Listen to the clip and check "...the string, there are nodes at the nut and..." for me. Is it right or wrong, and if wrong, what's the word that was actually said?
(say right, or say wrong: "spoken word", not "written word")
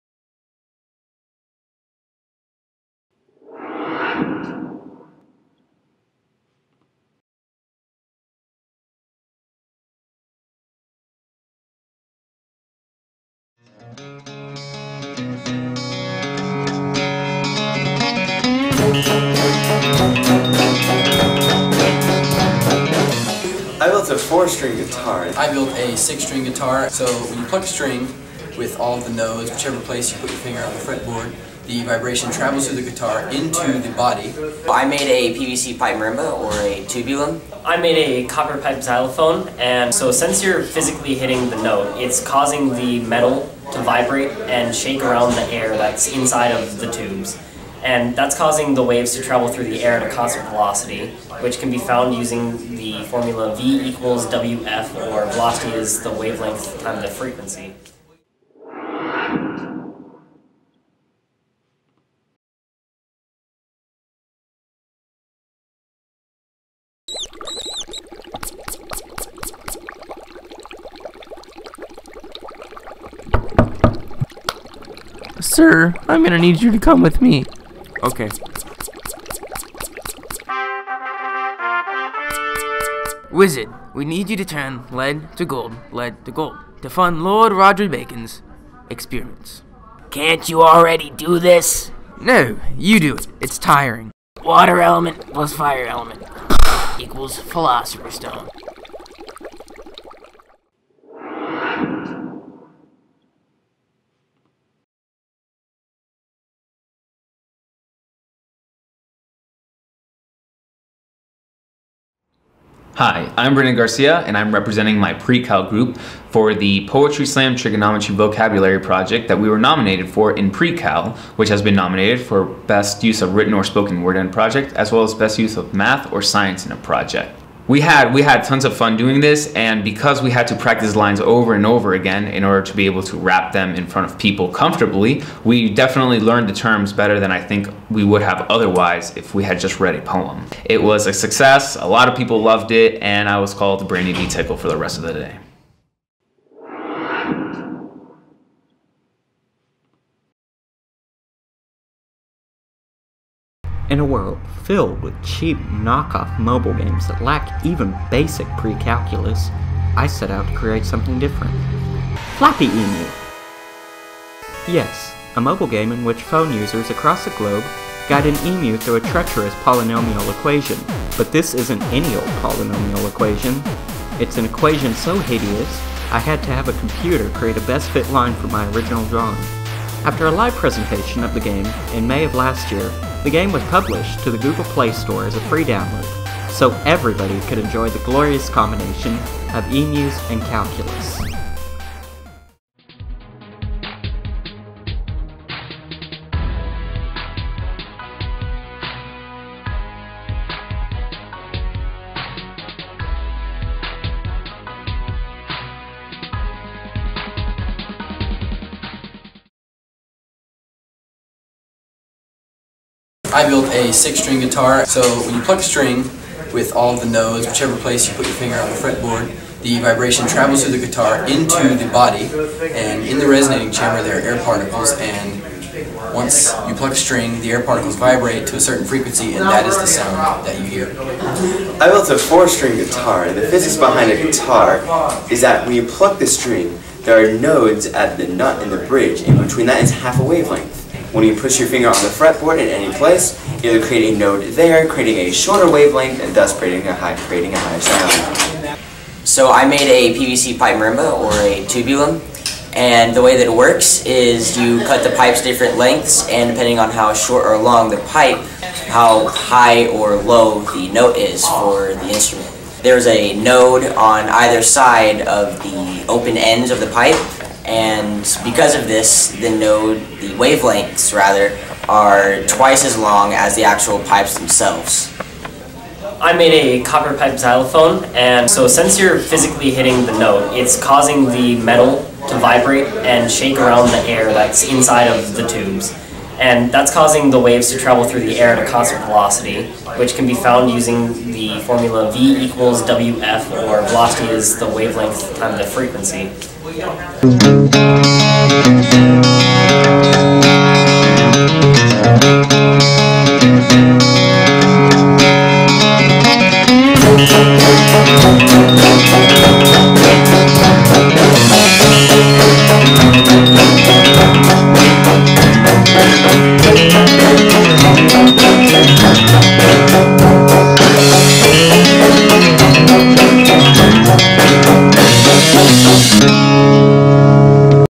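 right.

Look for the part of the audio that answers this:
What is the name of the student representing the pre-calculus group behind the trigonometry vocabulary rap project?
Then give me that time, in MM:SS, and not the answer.
01:53.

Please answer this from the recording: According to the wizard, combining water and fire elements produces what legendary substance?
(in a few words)
Philosopher's stone.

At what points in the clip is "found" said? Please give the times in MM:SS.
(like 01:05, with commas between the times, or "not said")
00:51, 04:50.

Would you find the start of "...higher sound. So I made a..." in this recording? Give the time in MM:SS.
04:07.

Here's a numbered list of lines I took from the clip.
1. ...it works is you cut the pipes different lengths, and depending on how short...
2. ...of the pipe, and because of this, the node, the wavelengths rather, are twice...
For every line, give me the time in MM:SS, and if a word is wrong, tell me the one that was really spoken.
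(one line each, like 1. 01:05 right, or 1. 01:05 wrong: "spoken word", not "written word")
1. 04:13 right
2. 04:26 right.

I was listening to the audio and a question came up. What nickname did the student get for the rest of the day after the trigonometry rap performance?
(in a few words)
Brandy D. Tickle.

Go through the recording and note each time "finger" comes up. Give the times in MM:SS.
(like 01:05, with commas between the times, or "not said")
00:30, 03:38, 04:01.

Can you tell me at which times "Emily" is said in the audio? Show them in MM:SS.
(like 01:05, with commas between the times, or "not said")
not said.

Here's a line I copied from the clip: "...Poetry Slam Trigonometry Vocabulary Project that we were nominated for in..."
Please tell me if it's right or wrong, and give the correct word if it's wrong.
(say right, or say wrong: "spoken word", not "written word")
right.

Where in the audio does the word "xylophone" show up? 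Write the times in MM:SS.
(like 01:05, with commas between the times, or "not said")
00:38, 04:37.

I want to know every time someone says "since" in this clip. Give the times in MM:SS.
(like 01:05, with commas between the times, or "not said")
00:40, 04:38.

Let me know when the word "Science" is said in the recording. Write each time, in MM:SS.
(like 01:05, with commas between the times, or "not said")
02:06.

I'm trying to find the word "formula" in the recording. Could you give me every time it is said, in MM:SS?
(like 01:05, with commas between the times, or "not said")
00:53, 04:51.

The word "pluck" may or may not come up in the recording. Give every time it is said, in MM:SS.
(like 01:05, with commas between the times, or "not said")
00:27, 03:35, 03:46, 03:55.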